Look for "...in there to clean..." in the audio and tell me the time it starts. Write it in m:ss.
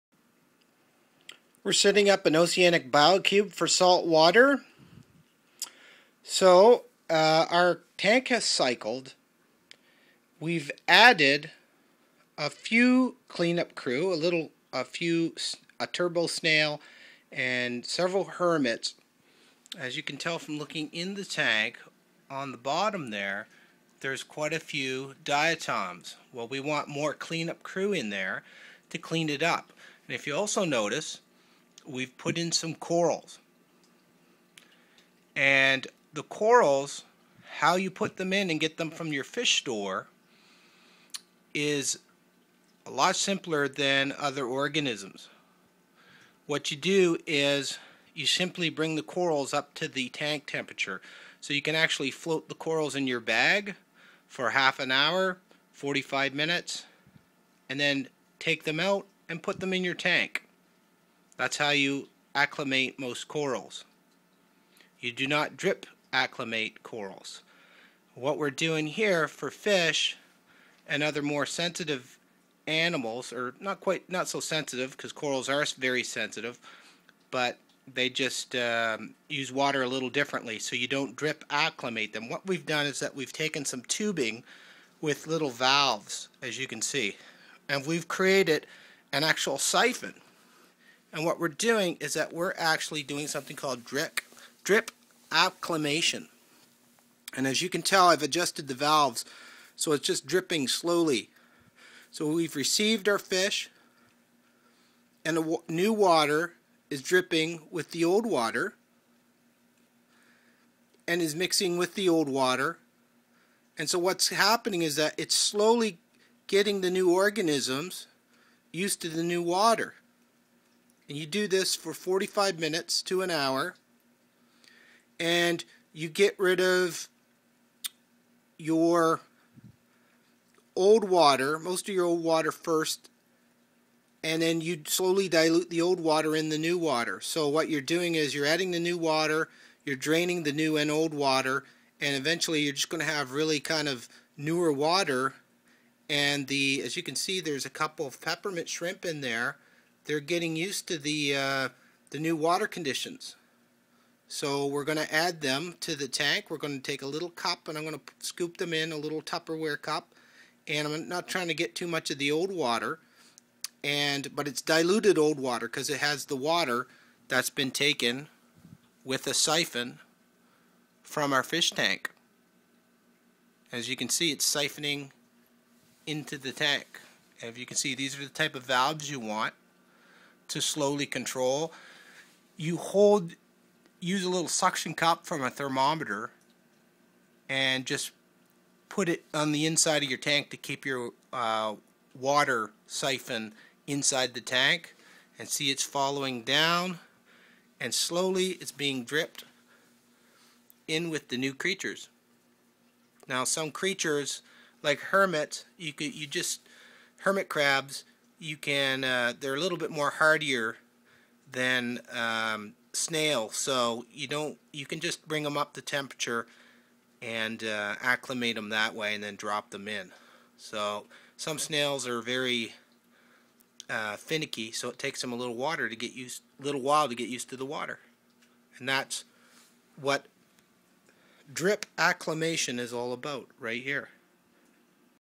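0:27.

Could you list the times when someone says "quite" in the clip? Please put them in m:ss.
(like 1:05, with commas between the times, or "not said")
0:24, 1:13.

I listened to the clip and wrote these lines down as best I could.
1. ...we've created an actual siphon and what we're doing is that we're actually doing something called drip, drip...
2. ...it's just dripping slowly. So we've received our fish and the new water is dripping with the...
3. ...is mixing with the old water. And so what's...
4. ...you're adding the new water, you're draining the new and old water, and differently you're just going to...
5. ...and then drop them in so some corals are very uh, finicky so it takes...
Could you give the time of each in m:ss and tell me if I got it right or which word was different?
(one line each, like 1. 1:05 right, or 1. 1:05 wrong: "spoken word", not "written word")
1. 1:27 right
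2. 1:39 right
3. 1:51 right
4. 2:18 wrong: "eventually", not "differently"
5. 3:39 wrong: "snails", not "corals".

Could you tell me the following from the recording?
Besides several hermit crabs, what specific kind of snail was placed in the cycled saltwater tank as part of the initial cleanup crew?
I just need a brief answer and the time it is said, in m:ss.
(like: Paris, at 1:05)
turbo snail, at 0:15.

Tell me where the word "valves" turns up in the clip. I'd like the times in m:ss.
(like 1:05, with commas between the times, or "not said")
1:25, 1:38, 2:58.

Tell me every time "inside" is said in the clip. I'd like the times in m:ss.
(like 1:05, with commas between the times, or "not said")
3:09, 3:13.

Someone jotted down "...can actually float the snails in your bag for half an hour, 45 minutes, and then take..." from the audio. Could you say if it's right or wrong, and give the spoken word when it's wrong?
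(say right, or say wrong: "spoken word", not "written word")
wrong: "corals", not "snails".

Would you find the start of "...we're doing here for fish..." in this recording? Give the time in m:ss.
1:08.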